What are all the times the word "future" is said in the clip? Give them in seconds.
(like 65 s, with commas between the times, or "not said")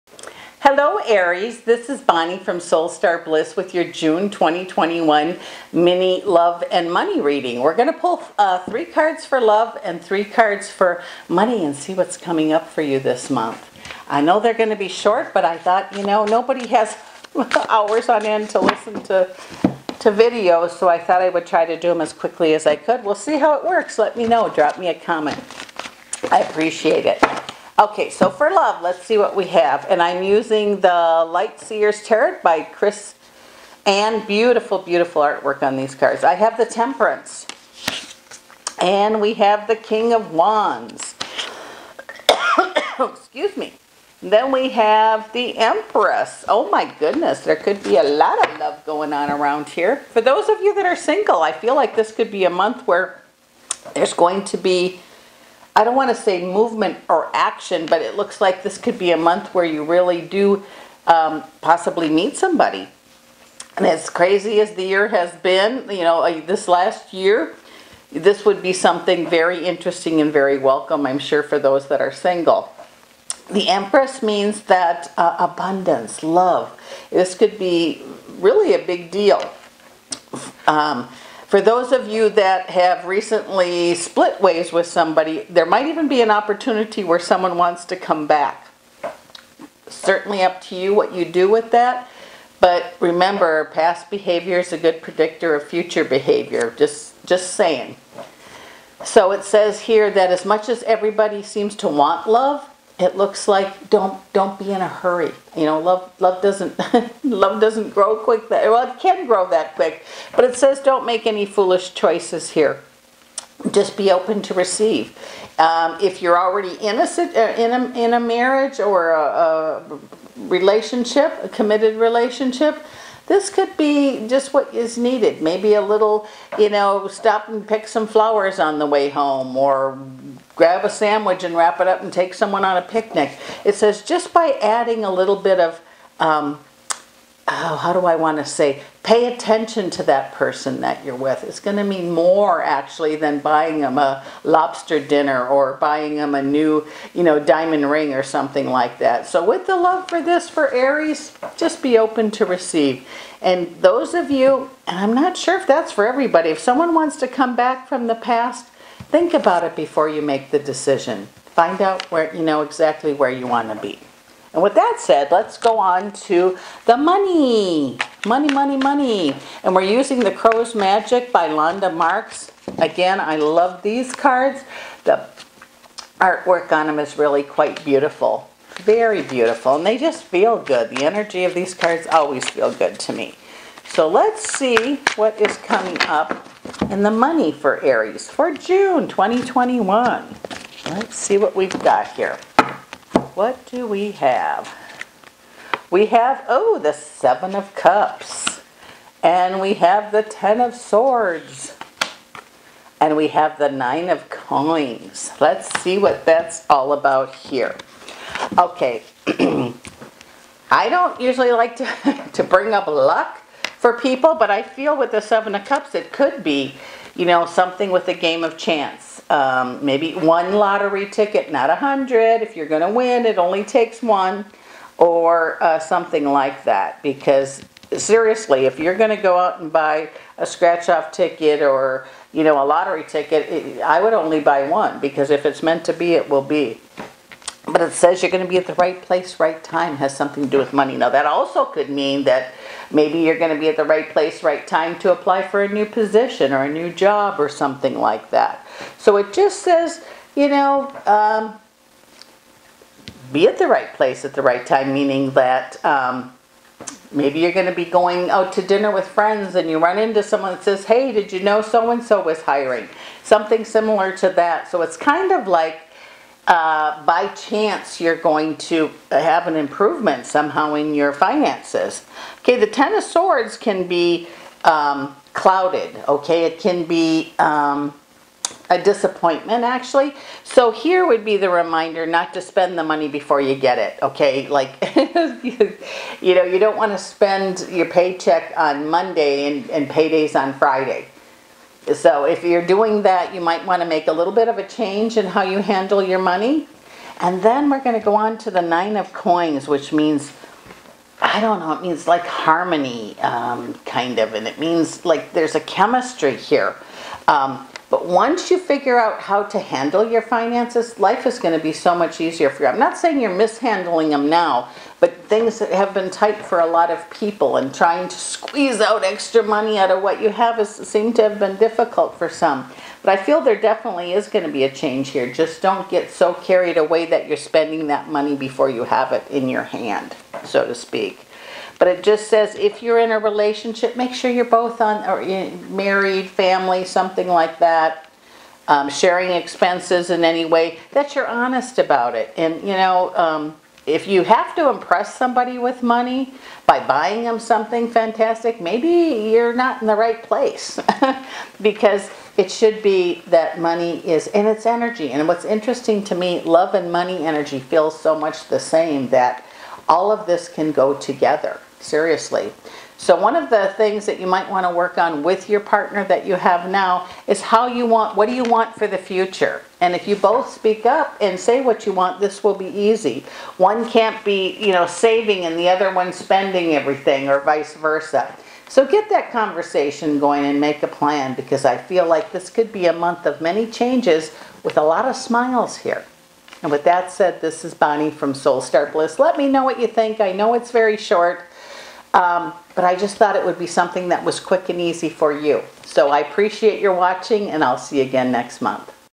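95 s, 368 s.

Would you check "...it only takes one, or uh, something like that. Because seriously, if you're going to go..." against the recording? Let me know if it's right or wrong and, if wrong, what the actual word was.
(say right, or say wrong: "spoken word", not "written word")
right.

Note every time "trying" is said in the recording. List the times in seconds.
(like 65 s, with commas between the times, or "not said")
317 s.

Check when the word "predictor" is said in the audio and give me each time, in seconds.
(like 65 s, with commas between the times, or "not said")
95 s.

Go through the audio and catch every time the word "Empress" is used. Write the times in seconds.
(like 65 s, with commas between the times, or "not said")
45 s, 73 s.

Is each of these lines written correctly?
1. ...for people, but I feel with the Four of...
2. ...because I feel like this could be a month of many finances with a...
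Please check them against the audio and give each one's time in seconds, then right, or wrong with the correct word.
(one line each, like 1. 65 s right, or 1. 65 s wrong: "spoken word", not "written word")
1. 213 s wrong: "Seven", not "Four"
2. 381 s wrong: "changes", not "finances".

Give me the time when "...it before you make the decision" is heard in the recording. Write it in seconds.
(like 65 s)
159 s.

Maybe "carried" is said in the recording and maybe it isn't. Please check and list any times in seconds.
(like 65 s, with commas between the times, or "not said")
326 s.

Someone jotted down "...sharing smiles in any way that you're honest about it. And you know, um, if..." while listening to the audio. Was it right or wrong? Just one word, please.
wrong.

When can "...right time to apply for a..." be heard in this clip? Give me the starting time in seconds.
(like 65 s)
244 s.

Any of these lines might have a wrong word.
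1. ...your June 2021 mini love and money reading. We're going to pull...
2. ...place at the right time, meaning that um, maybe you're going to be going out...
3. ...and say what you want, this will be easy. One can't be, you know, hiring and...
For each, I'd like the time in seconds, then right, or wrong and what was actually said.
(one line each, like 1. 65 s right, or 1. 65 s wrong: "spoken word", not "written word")
1. 3 s right
2. 253 s right
3. 371 s wrong: "saving", not "hiring".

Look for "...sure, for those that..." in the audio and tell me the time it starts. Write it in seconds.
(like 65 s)
71 s.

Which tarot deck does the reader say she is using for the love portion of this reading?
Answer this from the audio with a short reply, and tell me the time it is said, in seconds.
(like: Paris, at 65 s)
Light Seers Tarot, at 30 s.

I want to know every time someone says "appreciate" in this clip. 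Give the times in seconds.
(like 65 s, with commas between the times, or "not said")
26 s, 396 s.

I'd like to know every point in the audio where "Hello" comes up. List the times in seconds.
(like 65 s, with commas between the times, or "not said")
0 s.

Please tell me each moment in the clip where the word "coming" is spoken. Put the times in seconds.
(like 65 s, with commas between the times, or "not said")
12 s, 185 s.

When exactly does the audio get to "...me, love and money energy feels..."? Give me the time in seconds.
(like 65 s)
356 s.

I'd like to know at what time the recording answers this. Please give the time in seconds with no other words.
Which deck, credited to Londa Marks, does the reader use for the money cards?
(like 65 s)
170 s.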